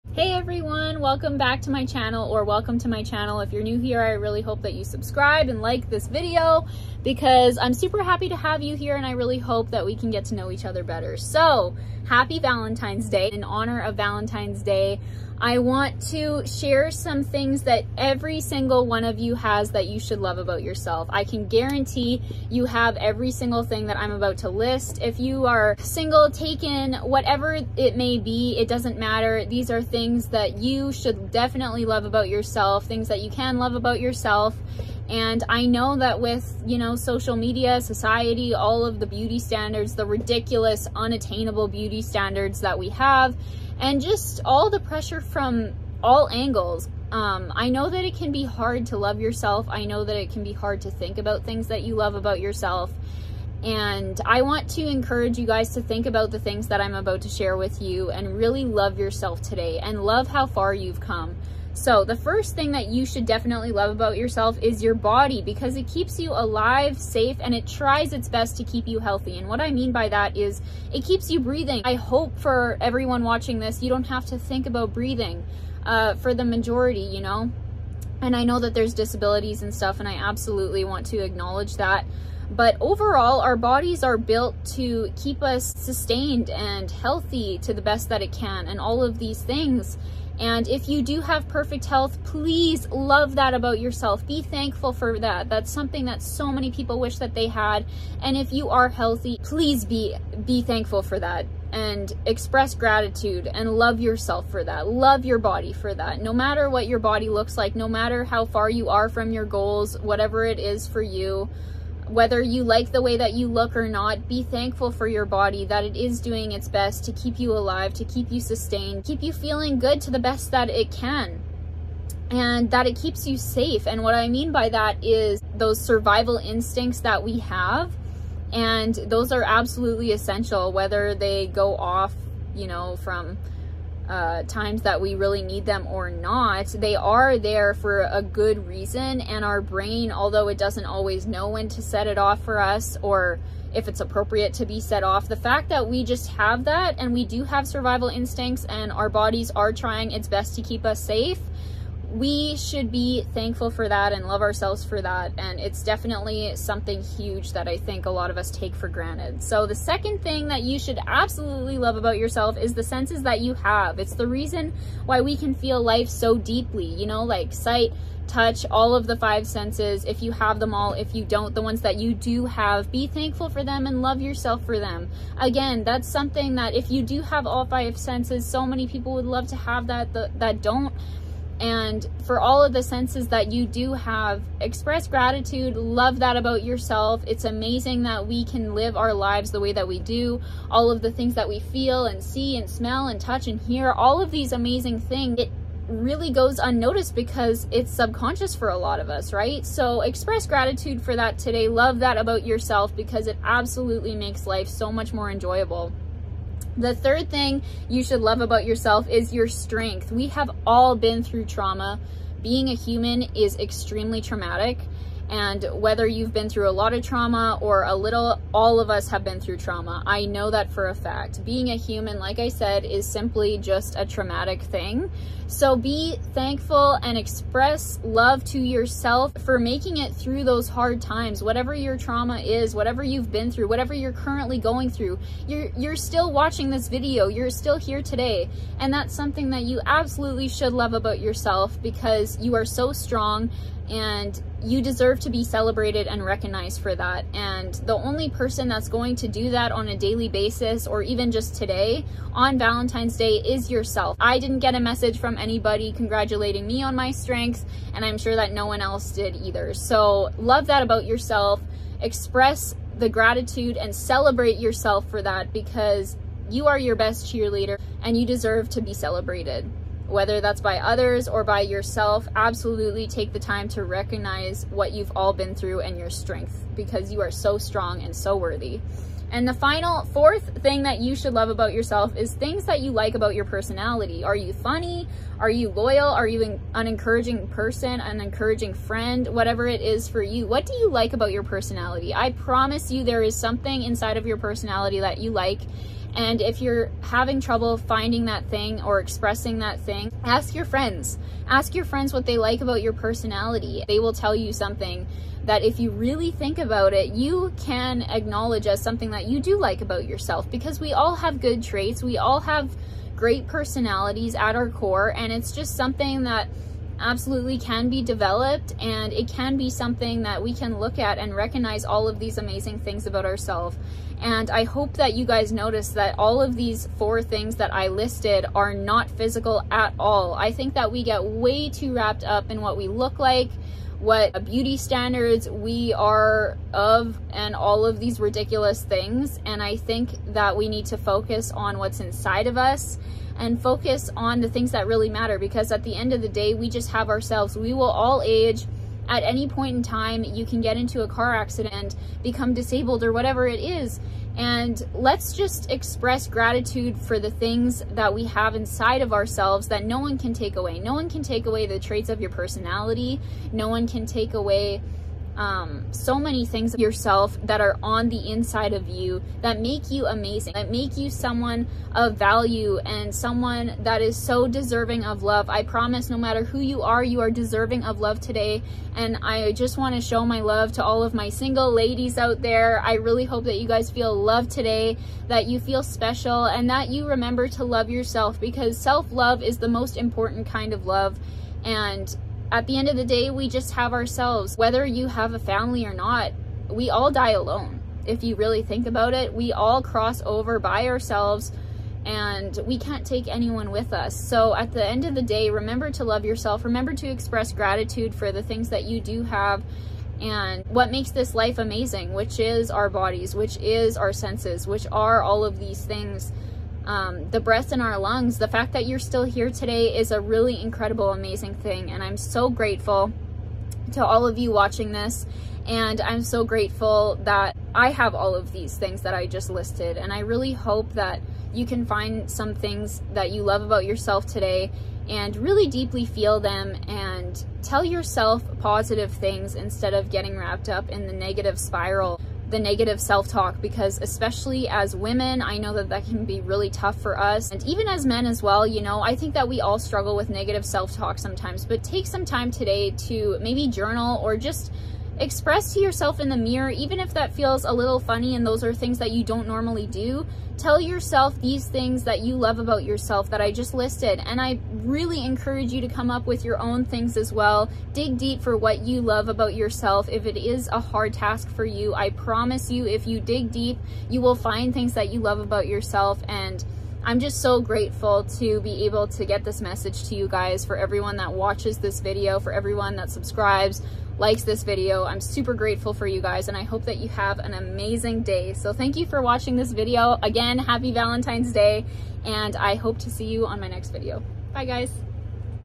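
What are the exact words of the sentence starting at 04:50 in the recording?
What do you like about your personality?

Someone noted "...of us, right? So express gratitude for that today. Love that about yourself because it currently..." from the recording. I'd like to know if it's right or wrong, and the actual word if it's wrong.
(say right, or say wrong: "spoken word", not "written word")
wrong: "absolutely", not "currently".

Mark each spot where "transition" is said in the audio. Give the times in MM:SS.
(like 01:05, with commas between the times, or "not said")
not said.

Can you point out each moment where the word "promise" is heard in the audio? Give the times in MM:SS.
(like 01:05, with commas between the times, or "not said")
04:52, 06:15, 07:52.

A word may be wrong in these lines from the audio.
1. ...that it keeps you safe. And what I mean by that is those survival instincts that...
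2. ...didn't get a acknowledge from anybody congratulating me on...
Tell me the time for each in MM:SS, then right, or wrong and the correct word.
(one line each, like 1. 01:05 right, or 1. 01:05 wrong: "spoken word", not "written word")
1. 02:02 right
2. 04:14 wrong: "message", not "acknowledge".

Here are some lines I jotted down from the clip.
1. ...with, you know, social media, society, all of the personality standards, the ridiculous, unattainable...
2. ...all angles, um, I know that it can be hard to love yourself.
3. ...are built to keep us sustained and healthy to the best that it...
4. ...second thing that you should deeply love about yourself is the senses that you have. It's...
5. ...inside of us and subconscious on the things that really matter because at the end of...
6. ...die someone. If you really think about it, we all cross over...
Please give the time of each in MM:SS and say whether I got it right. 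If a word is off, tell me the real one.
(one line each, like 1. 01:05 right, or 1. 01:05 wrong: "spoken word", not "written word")
1. 00:36 wrong: "beauty", not "personality"
2. 00:46 right
3. 01:24 right
4. 02:39 wrong: "absolutely", not "deeply"
5. 05:41 wrong: "focus", not "subconscious"
6. 06:37 wrong: "alone", not "someone".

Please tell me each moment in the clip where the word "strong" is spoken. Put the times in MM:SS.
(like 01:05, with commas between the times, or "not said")
04:02, 04:37.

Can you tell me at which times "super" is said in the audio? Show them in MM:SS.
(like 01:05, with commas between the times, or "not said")
00:07, 08:05.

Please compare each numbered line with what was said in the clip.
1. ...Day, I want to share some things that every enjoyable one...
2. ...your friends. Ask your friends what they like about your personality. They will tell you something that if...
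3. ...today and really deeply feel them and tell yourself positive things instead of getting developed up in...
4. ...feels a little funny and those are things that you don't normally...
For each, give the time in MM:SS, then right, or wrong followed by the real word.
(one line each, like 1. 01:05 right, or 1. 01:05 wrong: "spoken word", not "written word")
1. 00:14 wrong: "single", not "enjoyable"
2. 05:00 right
3. 07:14 wrong: "wrapped", not "developed"
4. 07:37 right.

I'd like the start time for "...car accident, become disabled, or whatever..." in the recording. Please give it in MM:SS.
05:51.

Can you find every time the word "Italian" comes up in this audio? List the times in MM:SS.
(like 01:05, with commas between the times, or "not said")
not said.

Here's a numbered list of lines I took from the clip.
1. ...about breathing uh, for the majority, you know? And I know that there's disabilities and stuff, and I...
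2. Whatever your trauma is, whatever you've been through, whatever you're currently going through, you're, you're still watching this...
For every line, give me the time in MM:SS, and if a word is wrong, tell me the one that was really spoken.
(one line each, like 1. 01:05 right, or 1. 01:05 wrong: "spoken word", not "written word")
1. 01:14 right
2. 03:51 right.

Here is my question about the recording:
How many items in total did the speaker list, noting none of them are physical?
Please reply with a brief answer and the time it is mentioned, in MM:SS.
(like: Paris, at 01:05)
4, at 05:26.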